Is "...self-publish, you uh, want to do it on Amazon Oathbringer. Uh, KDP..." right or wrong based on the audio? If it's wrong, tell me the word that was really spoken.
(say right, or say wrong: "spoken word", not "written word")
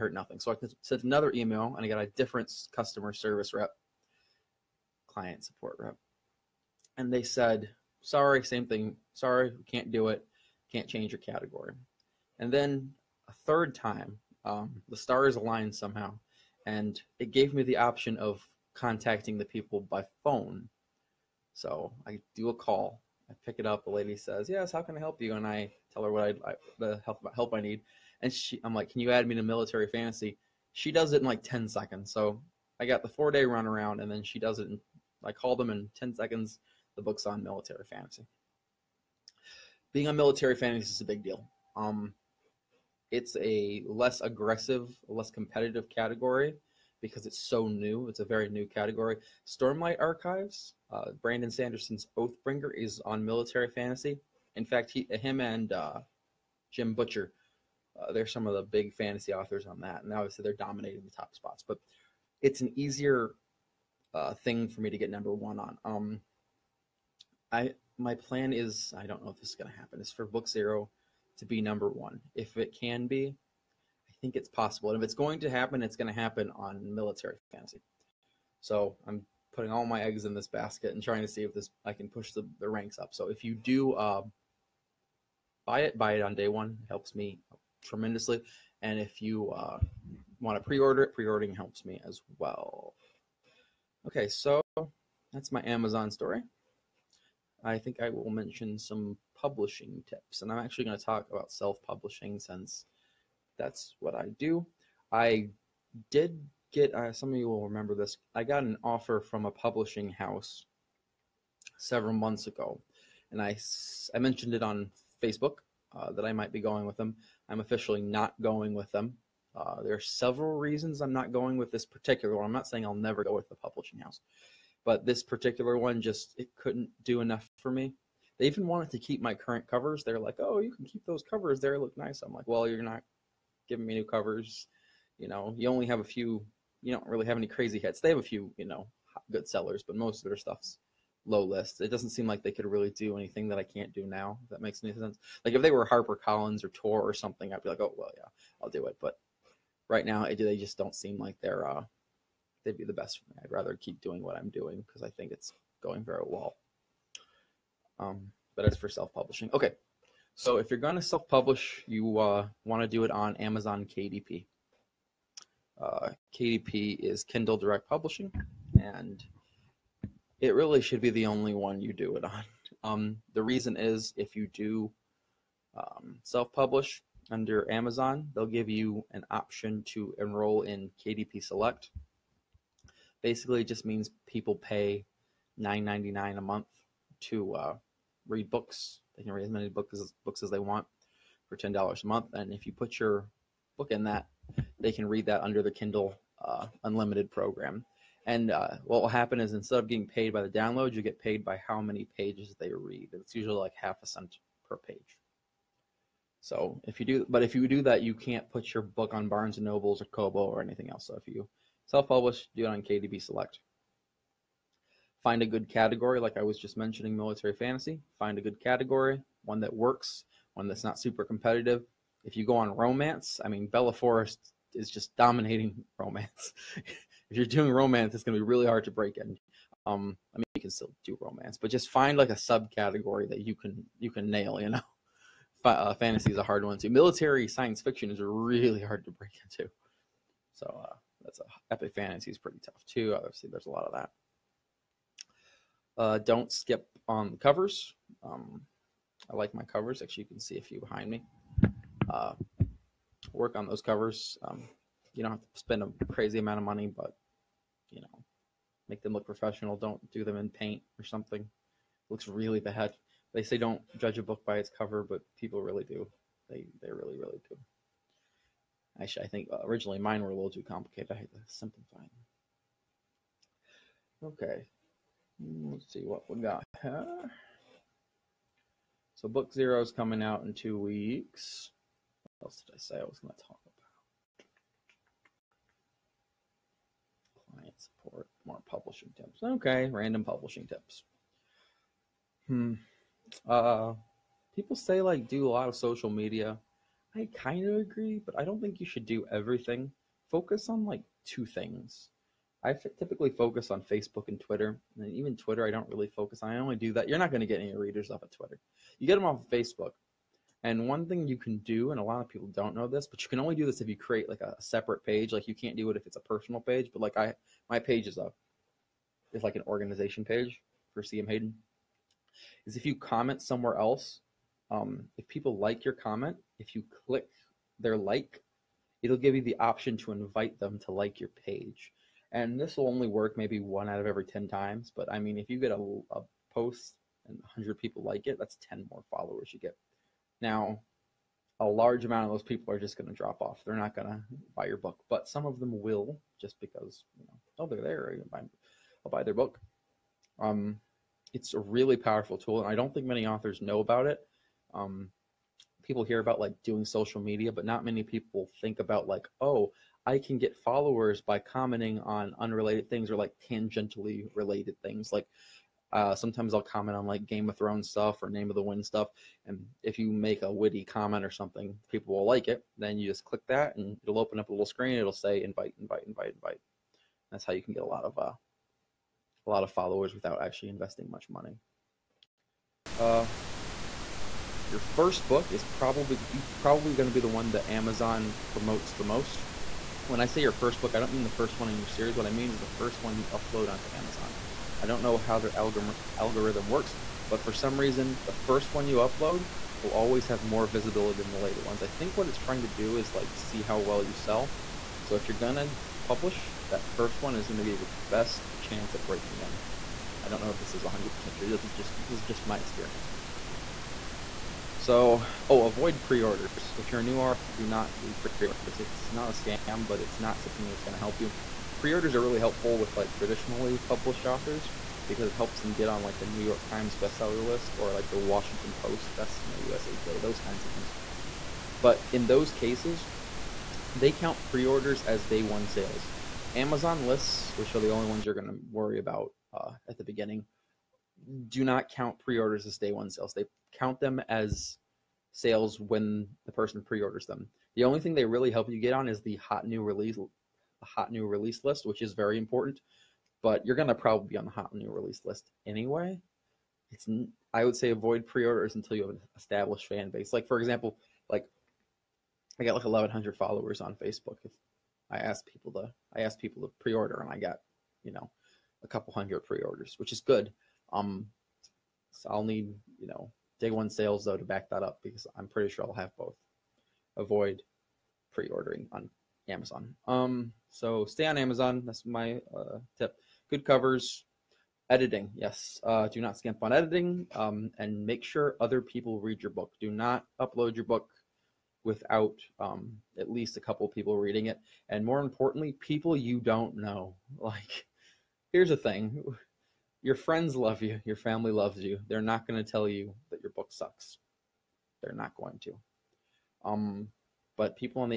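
wrong: "KDP", not "Oathbringer".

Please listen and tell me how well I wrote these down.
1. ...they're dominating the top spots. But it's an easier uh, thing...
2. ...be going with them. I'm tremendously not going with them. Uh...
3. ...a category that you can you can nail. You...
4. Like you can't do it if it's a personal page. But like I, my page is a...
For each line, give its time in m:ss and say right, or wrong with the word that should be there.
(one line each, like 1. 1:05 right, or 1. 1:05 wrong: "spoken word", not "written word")
1. 1:00 right
2. 1:56 wrong: "officially", not "tremendously"
3. 3:52 wrong: "subcategory", not "category"
4. 5:15 right.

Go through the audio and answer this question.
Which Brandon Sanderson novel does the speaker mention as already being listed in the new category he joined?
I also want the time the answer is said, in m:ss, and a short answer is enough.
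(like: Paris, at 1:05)
Oathbringer, at 0:52.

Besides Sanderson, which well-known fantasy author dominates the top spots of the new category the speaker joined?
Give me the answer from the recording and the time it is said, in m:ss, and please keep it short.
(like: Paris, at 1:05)
Jim Butcher, at 0:56.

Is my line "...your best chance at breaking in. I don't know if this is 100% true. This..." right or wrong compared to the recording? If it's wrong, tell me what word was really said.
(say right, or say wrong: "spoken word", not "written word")
right.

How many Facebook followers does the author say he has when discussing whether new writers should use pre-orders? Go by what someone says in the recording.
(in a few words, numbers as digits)
1,100.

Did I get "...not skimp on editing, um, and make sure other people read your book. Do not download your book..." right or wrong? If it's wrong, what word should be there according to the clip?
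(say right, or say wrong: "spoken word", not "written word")
wrong: "upload", not "download".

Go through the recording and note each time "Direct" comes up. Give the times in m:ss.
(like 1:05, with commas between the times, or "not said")
2:47.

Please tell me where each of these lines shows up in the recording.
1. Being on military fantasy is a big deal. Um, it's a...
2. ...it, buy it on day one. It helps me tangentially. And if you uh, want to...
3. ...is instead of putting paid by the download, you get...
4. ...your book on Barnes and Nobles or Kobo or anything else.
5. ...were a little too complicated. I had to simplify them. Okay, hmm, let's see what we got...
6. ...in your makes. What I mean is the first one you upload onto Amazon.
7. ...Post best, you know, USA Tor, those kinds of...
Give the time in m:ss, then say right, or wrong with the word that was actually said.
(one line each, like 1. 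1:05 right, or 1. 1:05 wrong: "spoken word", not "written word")
1. 0:39 right
2. 1:25 wrong: "tremendously", not "tangentially"
3. 3:19 wrong: "getting", not "putting"
4. 3:28 right
5. 4:30 right
6. 6:31 wrong: "series", not "makes"
7. 7:08 wrong: "Today", not "Tor".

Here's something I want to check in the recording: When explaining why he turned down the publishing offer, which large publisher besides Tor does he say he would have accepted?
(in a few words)
Harper Collins.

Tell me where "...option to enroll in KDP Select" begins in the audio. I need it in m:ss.
2:59.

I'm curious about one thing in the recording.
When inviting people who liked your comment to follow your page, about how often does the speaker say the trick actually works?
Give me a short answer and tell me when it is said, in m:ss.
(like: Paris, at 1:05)
1 out of every 10 times, at 5:33.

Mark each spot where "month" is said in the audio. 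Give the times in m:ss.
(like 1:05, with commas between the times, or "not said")
1:52, 3:06, 3:12.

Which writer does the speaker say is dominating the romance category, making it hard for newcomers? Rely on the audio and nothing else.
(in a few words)
Bella Forrest.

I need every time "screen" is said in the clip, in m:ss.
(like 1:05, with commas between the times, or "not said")
6:14.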